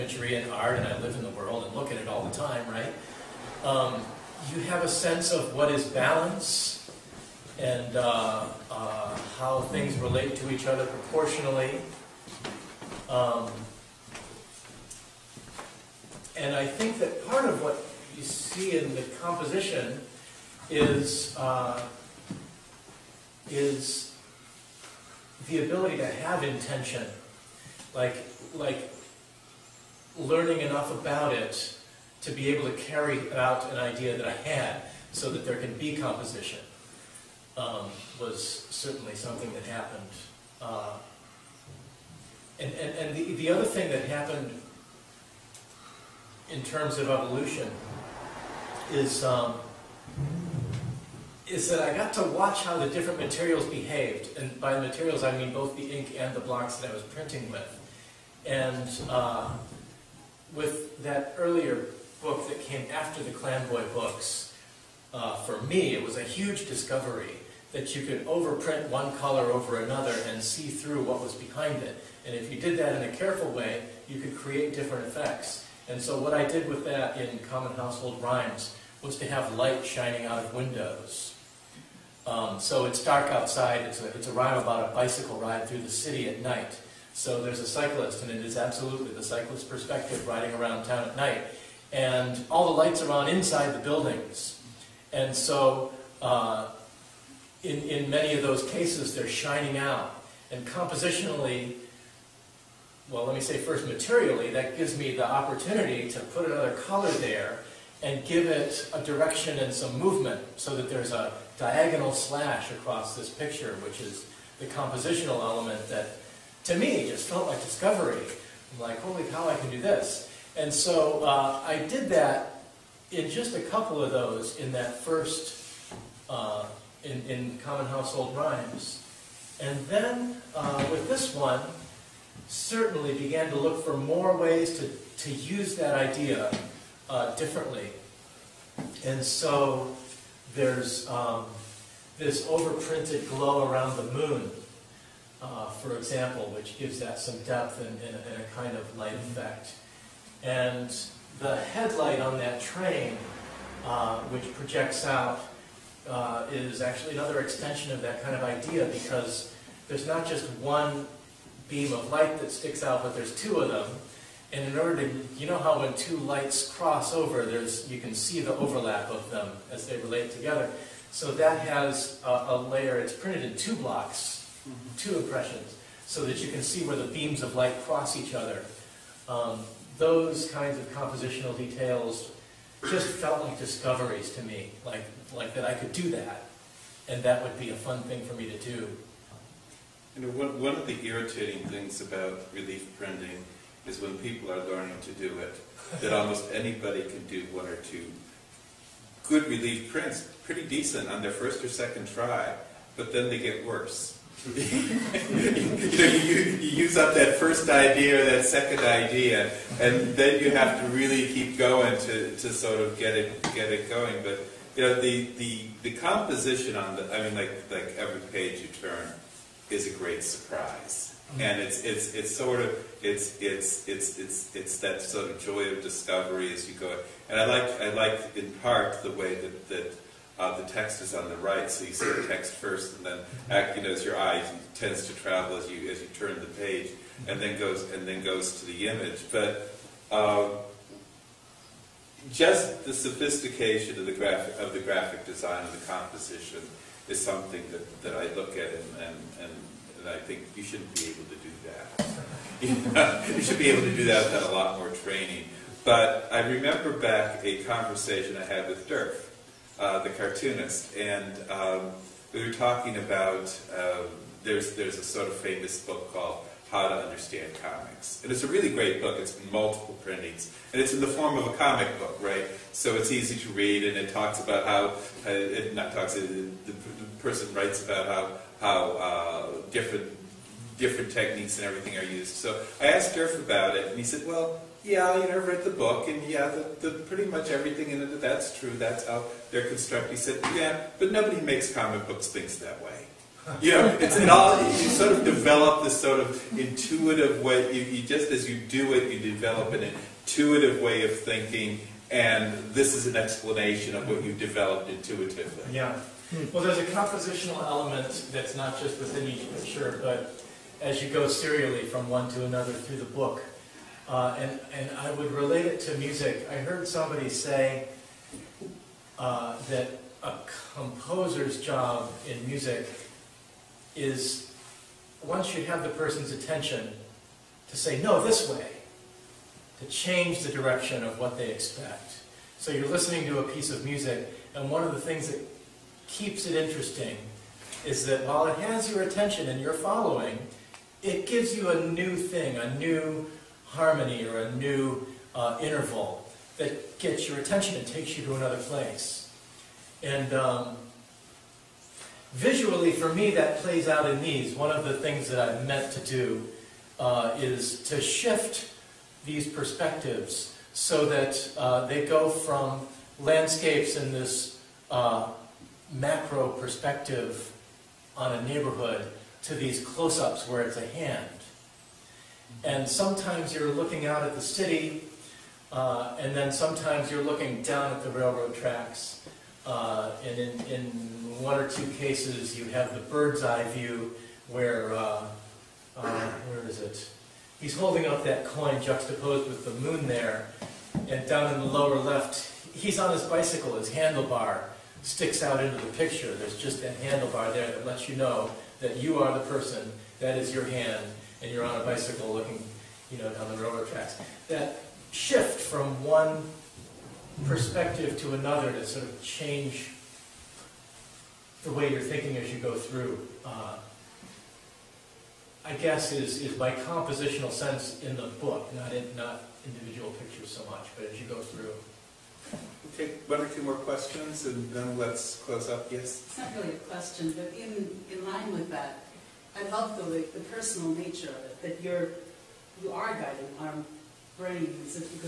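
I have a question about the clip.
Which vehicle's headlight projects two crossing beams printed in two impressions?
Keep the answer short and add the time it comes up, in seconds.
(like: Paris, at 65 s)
train, at 152 s.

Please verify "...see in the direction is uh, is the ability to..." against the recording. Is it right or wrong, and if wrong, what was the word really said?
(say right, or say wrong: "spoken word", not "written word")
wrong: "composition", not "direction".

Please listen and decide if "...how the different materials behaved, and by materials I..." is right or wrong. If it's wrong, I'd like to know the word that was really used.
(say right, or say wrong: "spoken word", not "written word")
right.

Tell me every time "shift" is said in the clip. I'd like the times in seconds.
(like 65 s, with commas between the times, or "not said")
357 s, 405 s.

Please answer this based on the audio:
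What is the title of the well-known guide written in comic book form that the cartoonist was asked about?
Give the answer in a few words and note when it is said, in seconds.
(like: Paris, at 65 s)
How to Understand Comics, at 266 s.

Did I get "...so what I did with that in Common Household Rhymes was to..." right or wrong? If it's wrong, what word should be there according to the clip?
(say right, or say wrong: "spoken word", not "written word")
right.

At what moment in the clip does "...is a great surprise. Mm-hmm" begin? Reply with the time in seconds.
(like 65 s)
219 s.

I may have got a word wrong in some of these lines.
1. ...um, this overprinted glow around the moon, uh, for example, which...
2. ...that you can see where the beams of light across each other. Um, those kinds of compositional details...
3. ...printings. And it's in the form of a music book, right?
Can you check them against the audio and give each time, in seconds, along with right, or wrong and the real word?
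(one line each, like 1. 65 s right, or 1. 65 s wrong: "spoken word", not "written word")
1. 141 s right
2. 176 s wrong: "cross", not "across"
3. 270 s wrong: "comic", not "music".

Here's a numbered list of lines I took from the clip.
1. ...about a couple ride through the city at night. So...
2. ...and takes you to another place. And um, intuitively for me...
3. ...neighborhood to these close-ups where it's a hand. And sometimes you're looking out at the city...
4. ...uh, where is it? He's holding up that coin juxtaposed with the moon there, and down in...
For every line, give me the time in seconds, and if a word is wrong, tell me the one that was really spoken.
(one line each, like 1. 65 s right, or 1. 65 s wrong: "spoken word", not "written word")
1. 84 s wrong: "bicycle", not "couple"
2. 347 s wrong: "visually", not "intuitively"
3. 368 s right
4. 385 s right.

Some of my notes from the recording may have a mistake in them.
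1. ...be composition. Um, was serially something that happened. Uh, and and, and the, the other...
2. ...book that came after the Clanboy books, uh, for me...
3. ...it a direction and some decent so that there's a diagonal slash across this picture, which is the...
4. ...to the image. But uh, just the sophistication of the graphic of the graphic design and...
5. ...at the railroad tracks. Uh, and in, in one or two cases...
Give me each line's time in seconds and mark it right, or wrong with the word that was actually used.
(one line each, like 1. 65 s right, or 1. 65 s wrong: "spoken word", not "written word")
1. 35 s wrong: "certainly", not "serially"
2. 62 s right
3. 108 s wrong: "movement", not "decent"
4. 238 s right
5. 377 s right.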